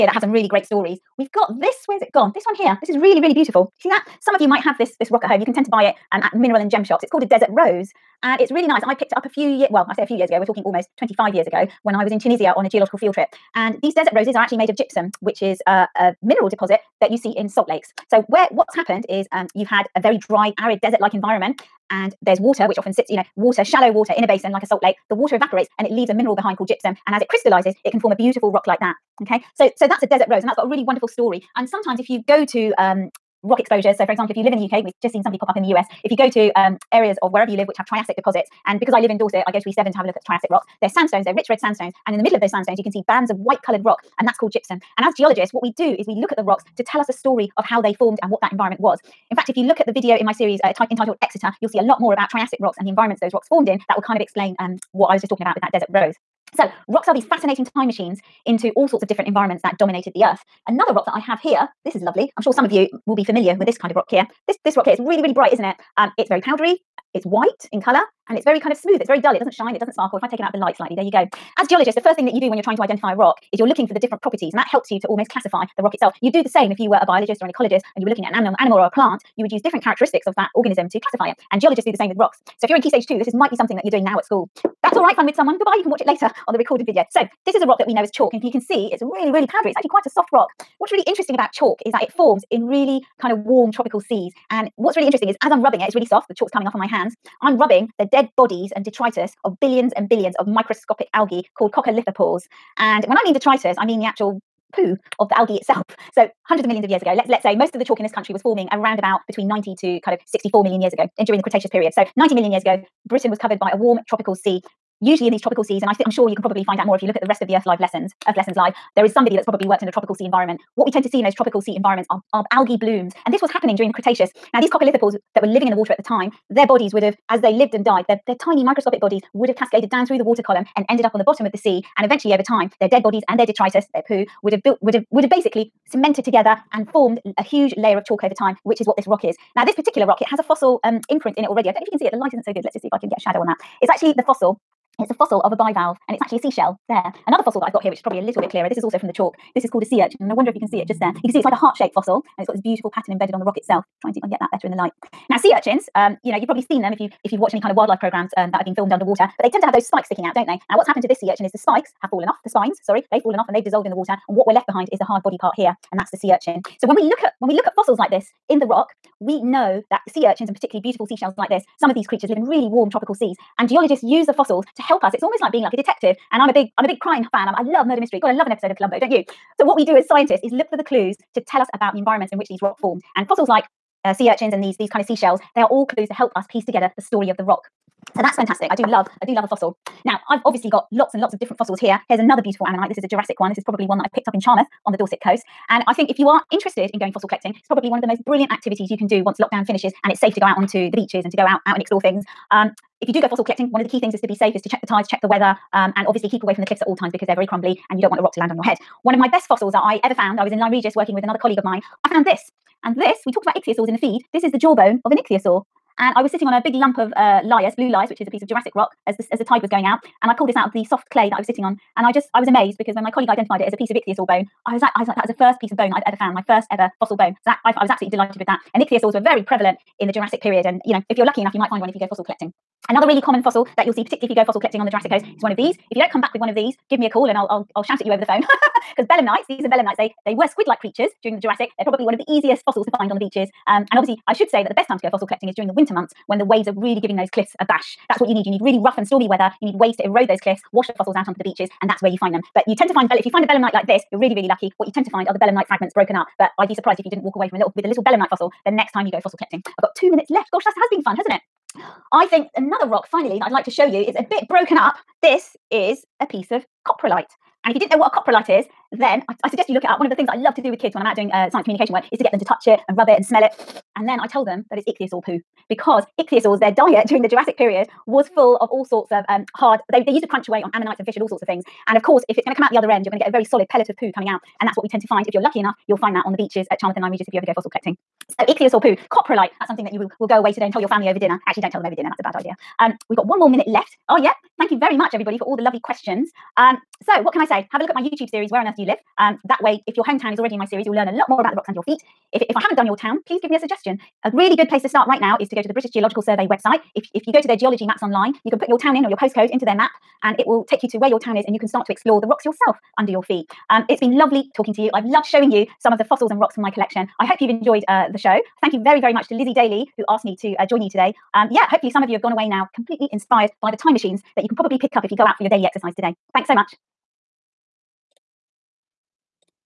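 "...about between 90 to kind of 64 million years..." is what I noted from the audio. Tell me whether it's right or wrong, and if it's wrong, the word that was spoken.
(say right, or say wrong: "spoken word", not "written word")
right.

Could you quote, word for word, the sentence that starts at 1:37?
I'm rubbing the dead bodies and detritus of billions and billions of microscopic algae called coccolithophores.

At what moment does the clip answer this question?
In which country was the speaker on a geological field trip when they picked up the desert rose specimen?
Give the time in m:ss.
0:12.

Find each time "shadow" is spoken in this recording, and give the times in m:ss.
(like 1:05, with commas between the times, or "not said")
2:23.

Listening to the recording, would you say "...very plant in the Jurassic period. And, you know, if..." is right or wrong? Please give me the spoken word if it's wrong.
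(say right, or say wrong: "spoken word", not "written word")
wrong: "prevalent", not "plant".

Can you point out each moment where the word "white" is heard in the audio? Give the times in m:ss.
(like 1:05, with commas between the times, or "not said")
0:43, 1:07.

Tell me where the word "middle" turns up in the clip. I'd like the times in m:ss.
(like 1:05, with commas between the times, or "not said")
0:42.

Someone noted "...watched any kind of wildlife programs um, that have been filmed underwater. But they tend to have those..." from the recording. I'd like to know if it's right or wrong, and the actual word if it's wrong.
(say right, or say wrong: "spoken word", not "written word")
right.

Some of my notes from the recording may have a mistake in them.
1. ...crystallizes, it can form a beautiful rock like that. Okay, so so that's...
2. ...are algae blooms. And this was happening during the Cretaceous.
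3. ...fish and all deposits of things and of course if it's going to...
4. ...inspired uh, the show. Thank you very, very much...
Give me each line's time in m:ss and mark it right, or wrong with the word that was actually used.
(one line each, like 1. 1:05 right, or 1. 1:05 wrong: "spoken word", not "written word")
1. 0:27 right
2. 2:02 right
3. 4:41 wrong: "sorts", not "deposits"
4. 5:17 wrong: "enjoyed", not "inspired".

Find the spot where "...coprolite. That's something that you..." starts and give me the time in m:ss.
4:49.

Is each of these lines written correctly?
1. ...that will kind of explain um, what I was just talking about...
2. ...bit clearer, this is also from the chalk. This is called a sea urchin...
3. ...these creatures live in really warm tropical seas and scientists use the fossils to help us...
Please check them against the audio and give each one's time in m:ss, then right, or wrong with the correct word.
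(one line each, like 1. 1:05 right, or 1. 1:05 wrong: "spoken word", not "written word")
1. 0:53 right
2. 2:28 right
3. 2:51 wrong: "geologists", not "scientists".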